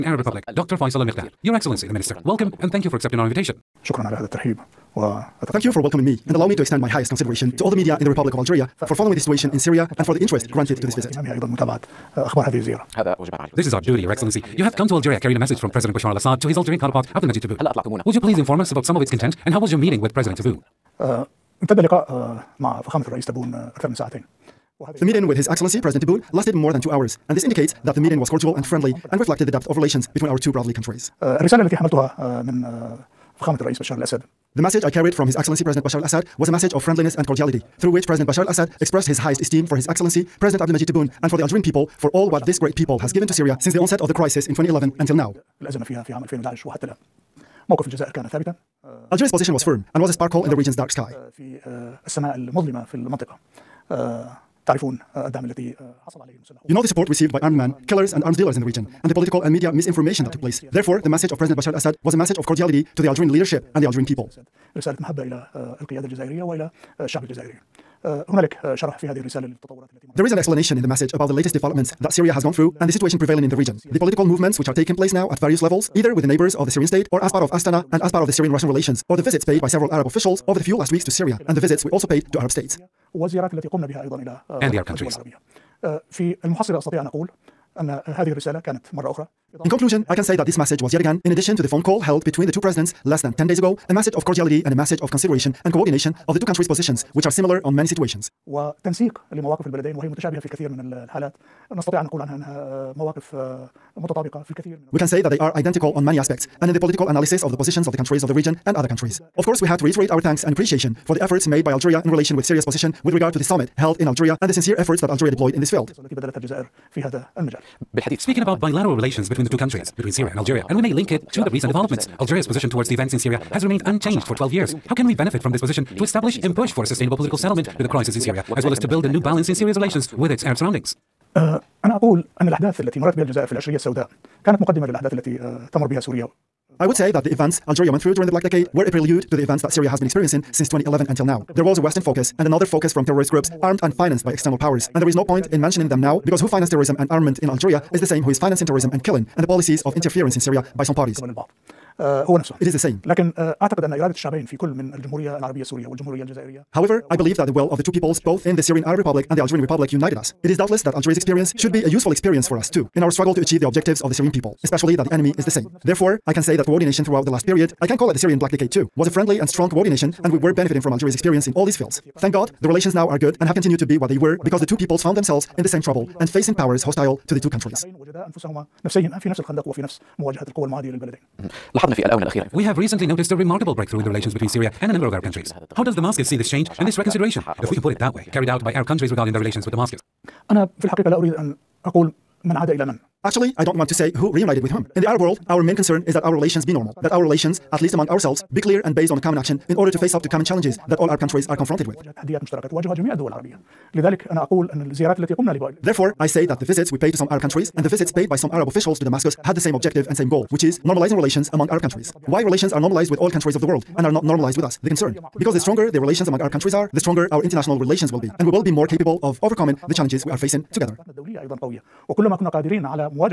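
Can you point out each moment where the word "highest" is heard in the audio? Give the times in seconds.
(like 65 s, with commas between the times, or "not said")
6 s, 39 s.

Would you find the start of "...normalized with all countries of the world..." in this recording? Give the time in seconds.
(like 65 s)
212 s.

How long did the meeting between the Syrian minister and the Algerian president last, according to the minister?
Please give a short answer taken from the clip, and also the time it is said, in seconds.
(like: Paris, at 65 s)
more than 2 hours, at 26 s.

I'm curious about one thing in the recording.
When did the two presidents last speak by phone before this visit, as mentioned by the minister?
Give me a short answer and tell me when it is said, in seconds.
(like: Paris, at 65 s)
less than 10 days ago, at 93 s.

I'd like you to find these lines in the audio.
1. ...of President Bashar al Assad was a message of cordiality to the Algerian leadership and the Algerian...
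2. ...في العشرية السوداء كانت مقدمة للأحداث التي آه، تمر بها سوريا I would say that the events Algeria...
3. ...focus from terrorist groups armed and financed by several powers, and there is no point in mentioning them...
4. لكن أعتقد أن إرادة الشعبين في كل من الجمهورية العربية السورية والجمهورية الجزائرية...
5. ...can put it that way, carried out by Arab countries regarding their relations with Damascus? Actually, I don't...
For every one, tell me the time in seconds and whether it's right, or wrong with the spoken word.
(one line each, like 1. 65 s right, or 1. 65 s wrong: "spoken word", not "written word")
1. 61 s right
2. 133 s right
3. 142 s wrong: "external", not "several"
4. 153 s right
5. 187 s right.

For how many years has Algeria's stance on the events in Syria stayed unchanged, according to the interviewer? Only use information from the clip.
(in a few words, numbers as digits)
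12 years.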